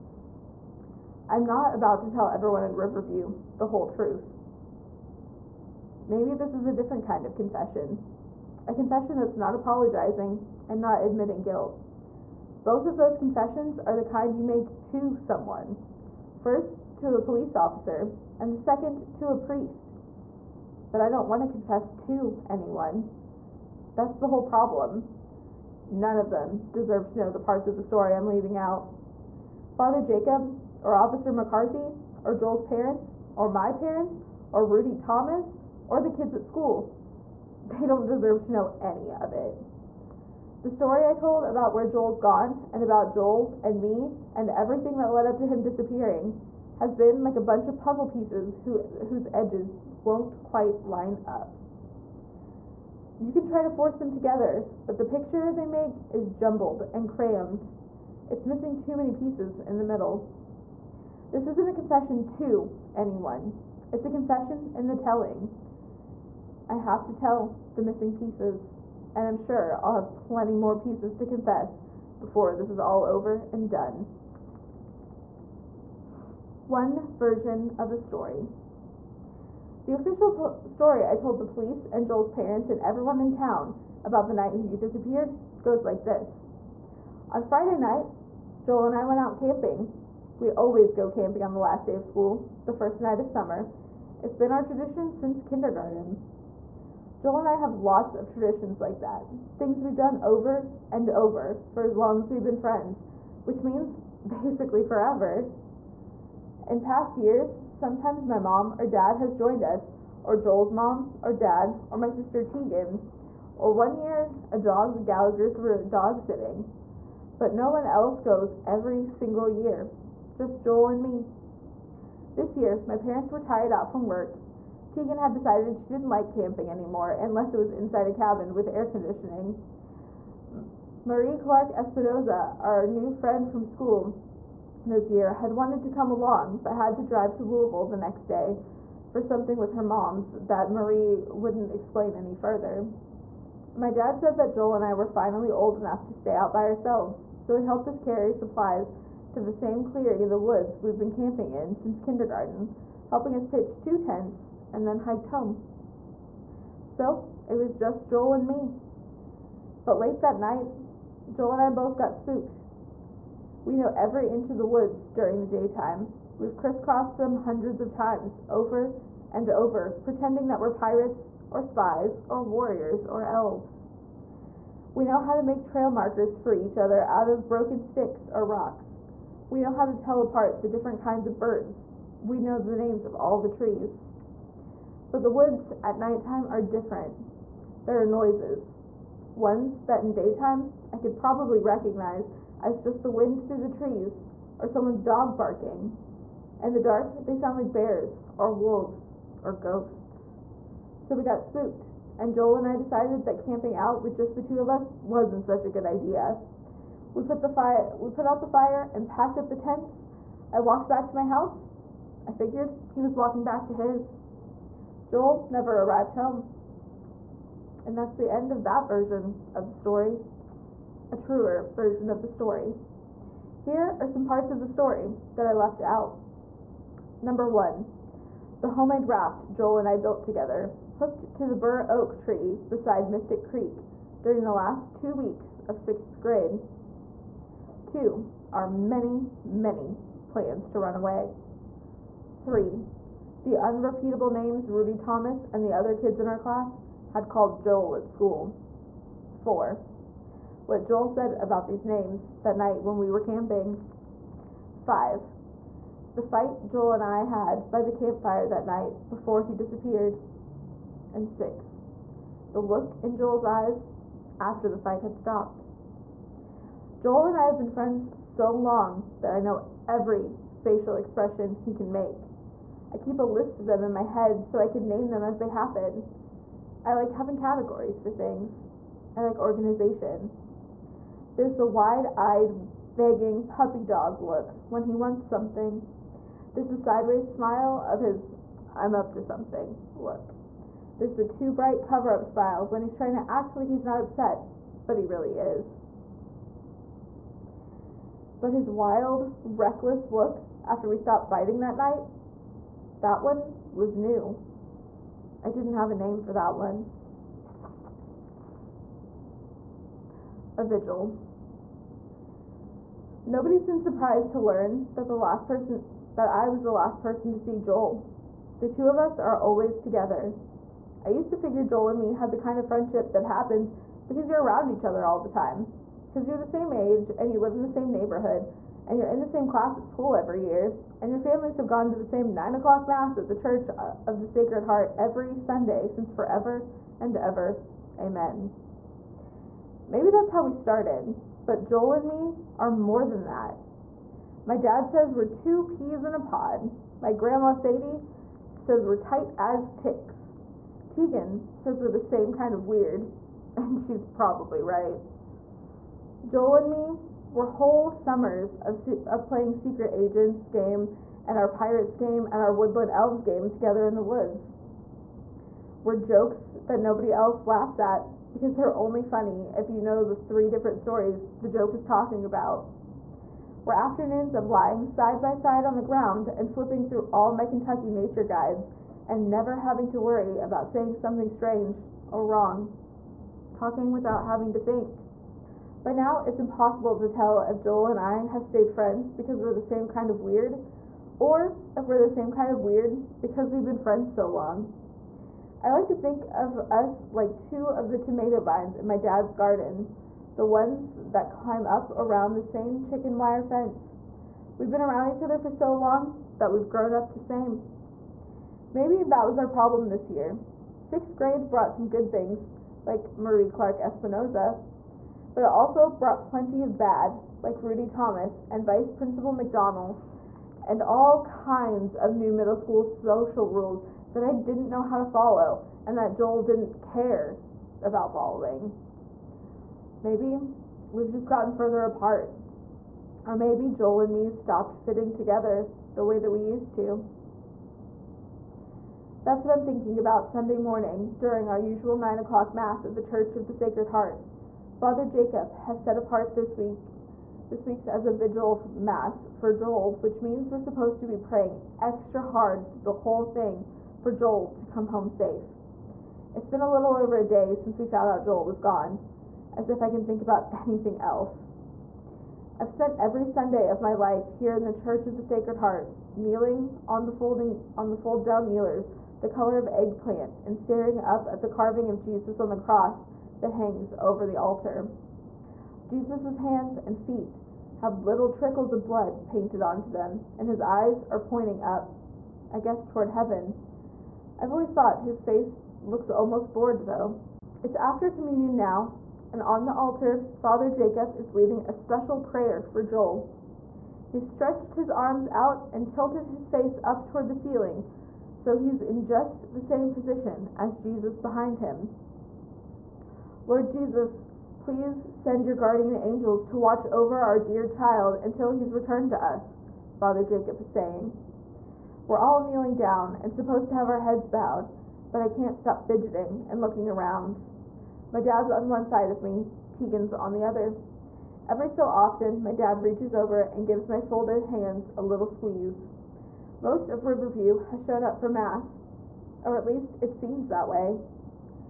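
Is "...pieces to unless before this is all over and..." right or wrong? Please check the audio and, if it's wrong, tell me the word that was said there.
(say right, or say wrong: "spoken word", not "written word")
wrong: "confess", not "unless".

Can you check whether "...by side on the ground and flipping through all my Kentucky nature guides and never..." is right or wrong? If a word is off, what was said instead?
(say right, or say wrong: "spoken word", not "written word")
right.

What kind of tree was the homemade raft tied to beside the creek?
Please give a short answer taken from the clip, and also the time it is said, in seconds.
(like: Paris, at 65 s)
burr oak, at 231 s.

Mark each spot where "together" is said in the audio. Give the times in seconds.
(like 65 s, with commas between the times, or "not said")
54 s, 230 s, 319 s, 363 s, 435 s.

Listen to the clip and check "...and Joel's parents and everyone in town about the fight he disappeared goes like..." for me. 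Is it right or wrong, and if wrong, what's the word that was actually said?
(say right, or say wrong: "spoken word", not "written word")
wrong: "night", not "fight".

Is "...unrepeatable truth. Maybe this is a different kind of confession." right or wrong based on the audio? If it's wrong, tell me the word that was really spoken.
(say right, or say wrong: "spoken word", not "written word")
wrong: "whole", not "unrepeatable".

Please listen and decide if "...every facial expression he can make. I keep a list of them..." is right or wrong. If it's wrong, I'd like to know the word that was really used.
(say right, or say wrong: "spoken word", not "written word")
right.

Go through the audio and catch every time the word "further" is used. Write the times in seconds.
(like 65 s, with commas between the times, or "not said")
142 s, 431 s.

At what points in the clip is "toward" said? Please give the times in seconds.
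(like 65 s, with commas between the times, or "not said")
482 s, 497 s.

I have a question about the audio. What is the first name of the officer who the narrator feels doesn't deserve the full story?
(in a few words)
McCarthy.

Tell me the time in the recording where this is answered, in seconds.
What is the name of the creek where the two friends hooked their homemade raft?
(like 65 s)
233 s.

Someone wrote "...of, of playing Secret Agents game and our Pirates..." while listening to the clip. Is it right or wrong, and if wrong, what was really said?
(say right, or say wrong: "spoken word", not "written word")
right.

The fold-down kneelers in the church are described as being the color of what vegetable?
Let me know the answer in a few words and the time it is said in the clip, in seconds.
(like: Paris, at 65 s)
eggplant, at 469 s.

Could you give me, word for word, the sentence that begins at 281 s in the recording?
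There's the wide-eyed, begging puppy dog look when he wants something.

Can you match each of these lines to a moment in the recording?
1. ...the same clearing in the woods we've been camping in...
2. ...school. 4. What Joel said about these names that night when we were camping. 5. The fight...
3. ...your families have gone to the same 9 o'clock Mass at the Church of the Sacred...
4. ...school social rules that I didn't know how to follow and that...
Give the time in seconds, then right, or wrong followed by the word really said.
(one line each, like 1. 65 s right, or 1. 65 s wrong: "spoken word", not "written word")
1. 149 s right
2. 248 s right
3. 331 s right
4. 422 s right.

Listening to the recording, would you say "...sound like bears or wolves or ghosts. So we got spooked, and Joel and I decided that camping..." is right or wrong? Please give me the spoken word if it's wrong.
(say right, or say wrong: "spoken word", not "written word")
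right.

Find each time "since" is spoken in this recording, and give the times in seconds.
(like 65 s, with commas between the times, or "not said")
95 s, 151 s, 335 s, 457 s.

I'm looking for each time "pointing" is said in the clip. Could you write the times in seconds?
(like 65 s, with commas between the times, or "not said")
481 s.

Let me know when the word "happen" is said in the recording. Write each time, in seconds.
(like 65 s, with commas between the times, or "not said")
275 s, 323 s.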